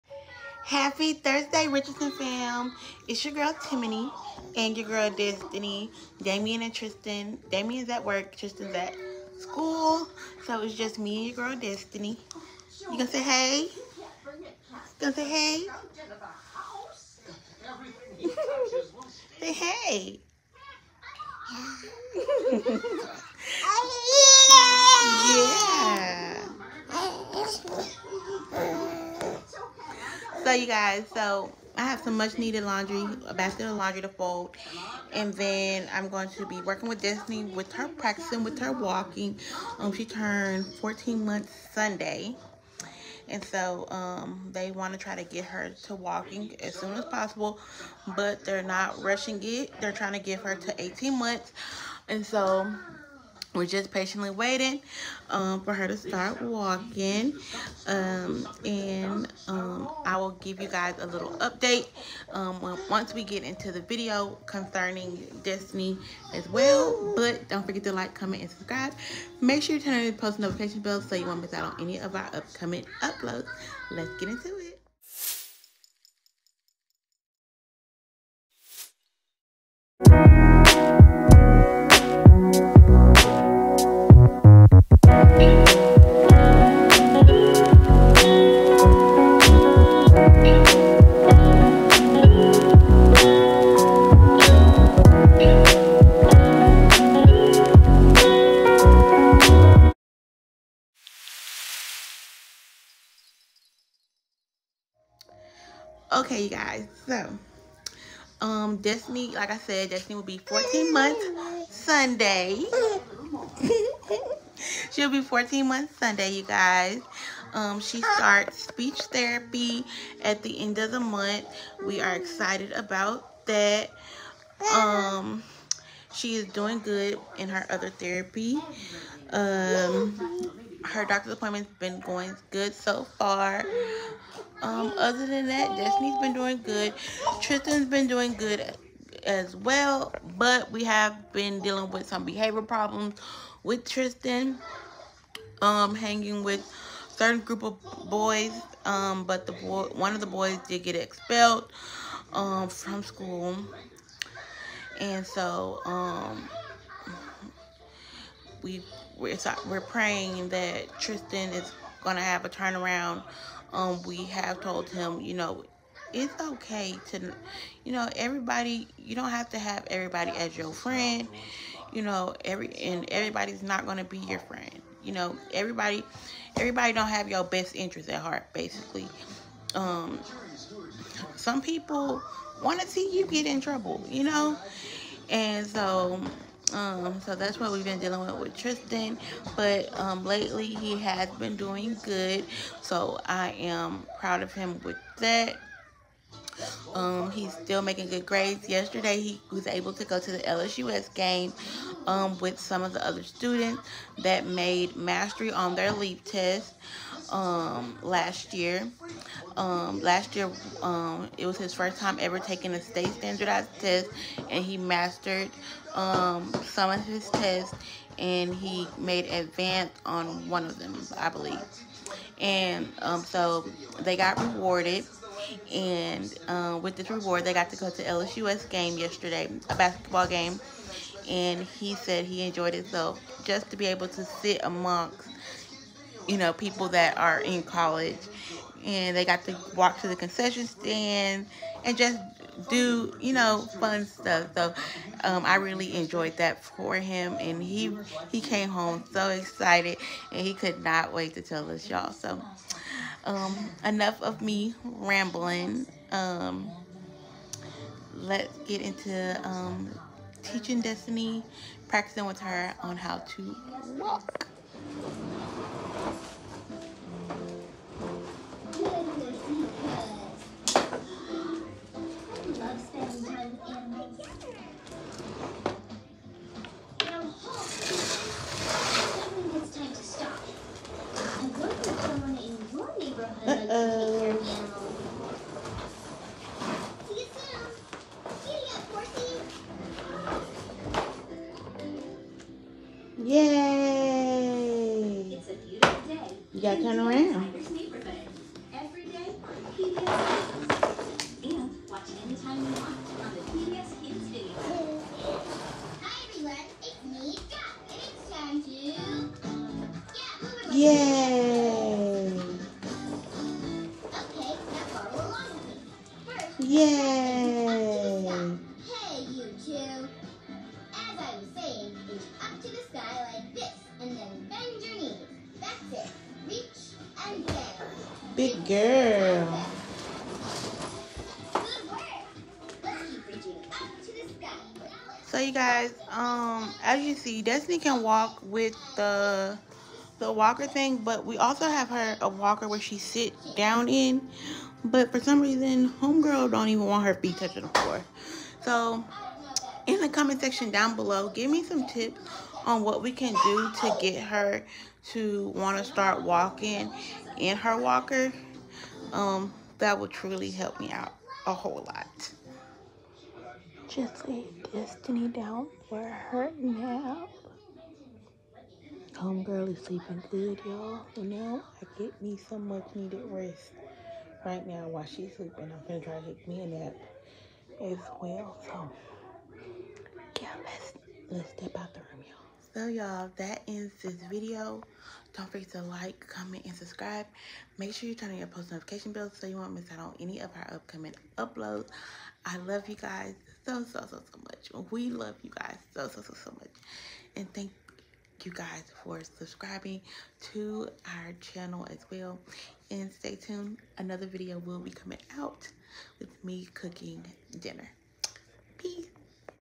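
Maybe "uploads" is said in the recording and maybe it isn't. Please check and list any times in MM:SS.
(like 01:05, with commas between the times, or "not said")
01:13, 06:31.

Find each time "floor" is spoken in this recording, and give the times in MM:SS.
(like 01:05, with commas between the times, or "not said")
05:47.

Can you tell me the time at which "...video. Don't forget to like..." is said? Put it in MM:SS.
06:24.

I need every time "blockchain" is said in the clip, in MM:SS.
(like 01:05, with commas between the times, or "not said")
not said.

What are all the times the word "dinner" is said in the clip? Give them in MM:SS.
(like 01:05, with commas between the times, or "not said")
06:47.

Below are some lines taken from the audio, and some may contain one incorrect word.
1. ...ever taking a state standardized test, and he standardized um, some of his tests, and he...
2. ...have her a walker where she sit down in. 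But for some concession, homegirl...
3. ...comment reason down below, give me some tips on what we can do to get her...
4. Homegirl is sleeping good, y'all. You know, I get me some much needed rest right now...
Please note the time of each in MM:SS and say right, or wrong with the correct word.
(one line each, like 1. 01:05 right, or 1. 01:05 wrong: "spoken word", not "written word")
1. 03:32 wrong: "mastered", not "standardized"
2. 05:41 wrong: "reason", not "concession"
3. 05:50 wrong: "section", not "reason"
4. 06:09 right.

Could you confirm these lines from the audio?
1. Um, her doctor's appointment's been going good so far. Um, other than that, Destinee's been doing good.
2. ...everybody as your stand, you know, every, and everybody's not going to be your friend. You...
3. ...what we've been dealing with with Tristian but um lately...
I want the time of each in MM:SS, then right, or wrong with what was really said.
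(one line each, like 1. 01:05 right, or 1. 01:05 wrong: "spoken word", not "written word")
1. 02:09 right
2. 02:49 wrong: "friend", not "stand"
3. 03:07 right.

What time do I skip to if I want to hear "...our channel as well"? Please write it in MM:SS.
06:41.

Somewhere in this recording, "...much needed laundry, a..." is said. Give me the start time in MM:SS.
00:32.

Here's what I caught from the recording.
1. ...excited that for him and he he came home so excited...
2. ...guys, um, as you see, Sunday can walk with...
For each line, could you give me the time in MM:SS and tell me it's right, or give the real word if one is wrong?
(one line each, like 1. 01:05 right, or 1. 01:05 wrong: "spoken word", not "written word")
1. 04:05 wrong: "enjoyed", not "excited"
2. 05:35 wrong: "Destinee", not "Sunday".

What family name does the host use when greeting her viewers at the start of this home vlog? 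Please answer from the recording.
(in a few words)
Richardson.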